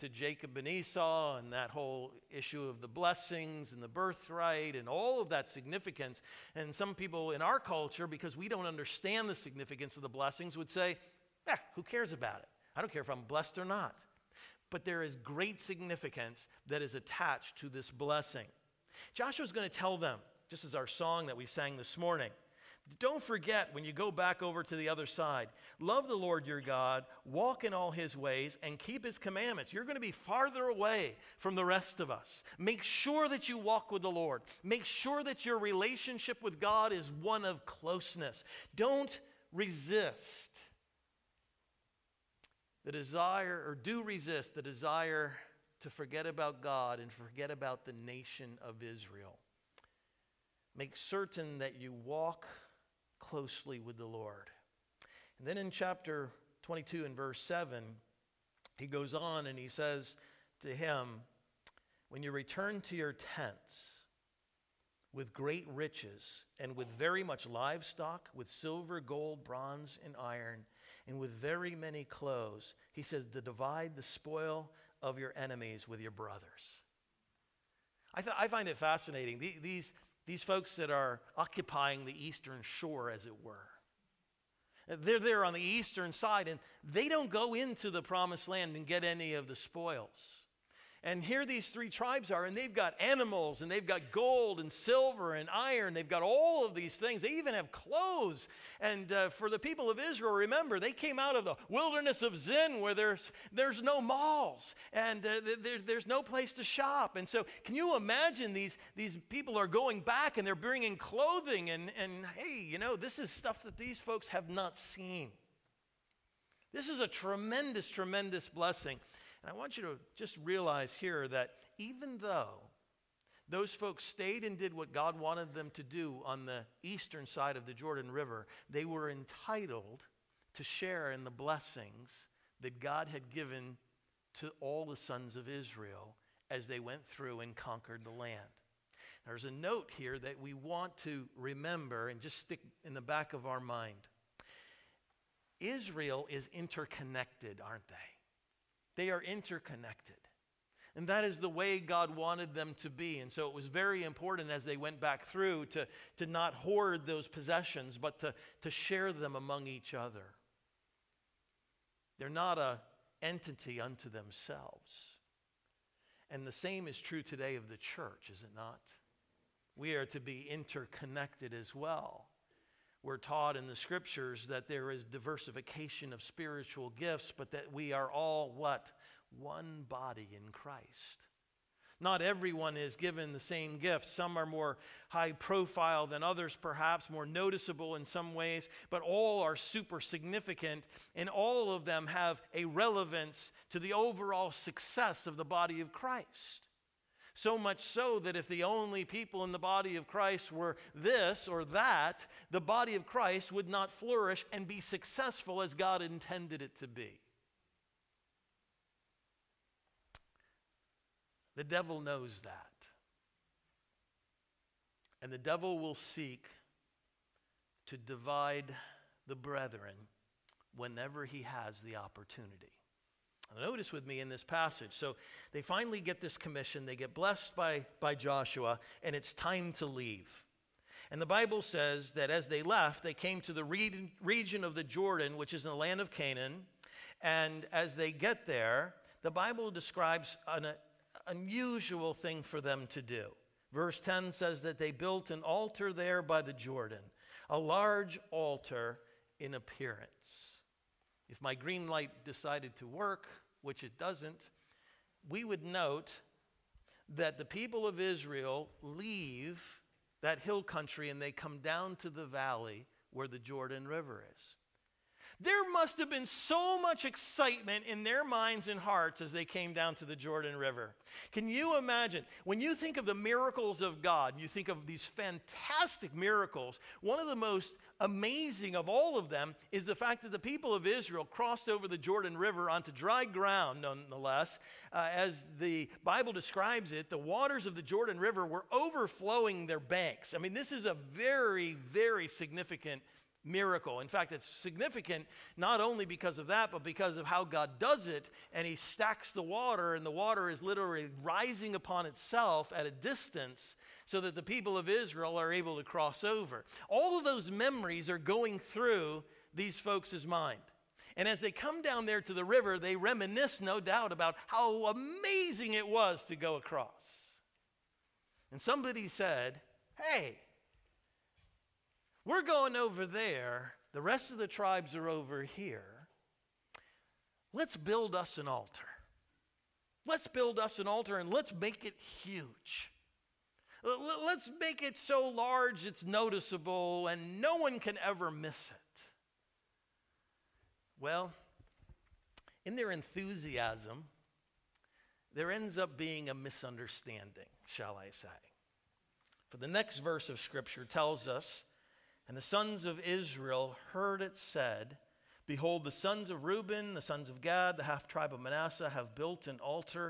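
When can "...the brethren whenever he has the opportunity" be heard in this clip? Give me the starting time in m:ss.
3:39.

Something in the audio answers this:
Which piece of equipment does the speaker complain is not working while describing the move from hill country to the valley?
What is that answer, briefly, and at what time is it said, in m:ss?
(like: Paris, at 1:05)
Green light, at 4:11.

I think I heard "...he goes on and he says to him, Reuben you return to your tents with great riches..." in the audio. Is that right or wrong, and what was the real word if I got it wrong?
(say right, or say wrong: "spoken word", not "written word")
wrong: "When", not "Reuben".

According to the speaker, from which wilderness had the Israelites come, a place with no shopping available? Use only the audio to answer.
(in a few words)
Wilderness of Zin.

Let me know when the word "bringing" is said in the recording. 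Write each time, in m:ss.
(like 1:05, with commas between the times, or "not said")
1:50.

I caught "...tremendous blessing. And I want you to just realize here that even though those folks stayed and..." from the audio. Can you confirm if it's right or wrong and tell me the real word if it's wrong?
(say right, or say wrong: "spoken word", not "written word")
right.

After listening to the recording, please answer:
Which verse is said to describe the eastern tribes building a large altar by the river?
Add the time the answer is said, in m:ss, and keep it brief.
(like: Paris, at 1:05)
Verse 10, at 4:03.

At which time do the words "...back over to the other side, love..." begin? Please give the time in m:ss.
0:24.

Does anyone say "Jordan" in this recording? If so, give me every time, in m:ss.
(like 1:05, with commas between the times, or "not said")
2:07, 3:54, 4:06, 4:23, 4:30, 4:41, 4:47.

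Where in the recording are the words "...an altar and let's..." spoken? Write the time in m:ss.
5:30.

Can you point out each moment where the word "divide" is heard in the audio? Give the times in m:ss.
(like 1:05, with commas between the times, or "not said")
1:13, 3:37.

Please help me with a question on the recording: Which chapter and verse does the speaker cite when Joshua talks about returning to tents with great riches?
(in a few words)
Chapter 22, verse 7.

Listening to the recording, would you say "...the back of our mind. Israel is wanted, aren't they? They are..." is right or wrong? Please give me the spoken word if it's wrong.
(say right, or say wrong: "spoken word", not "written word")
wrong: "interconnected", not "wanted".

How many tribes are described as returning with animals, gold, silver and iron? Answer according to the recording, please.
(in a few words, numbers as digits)
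3.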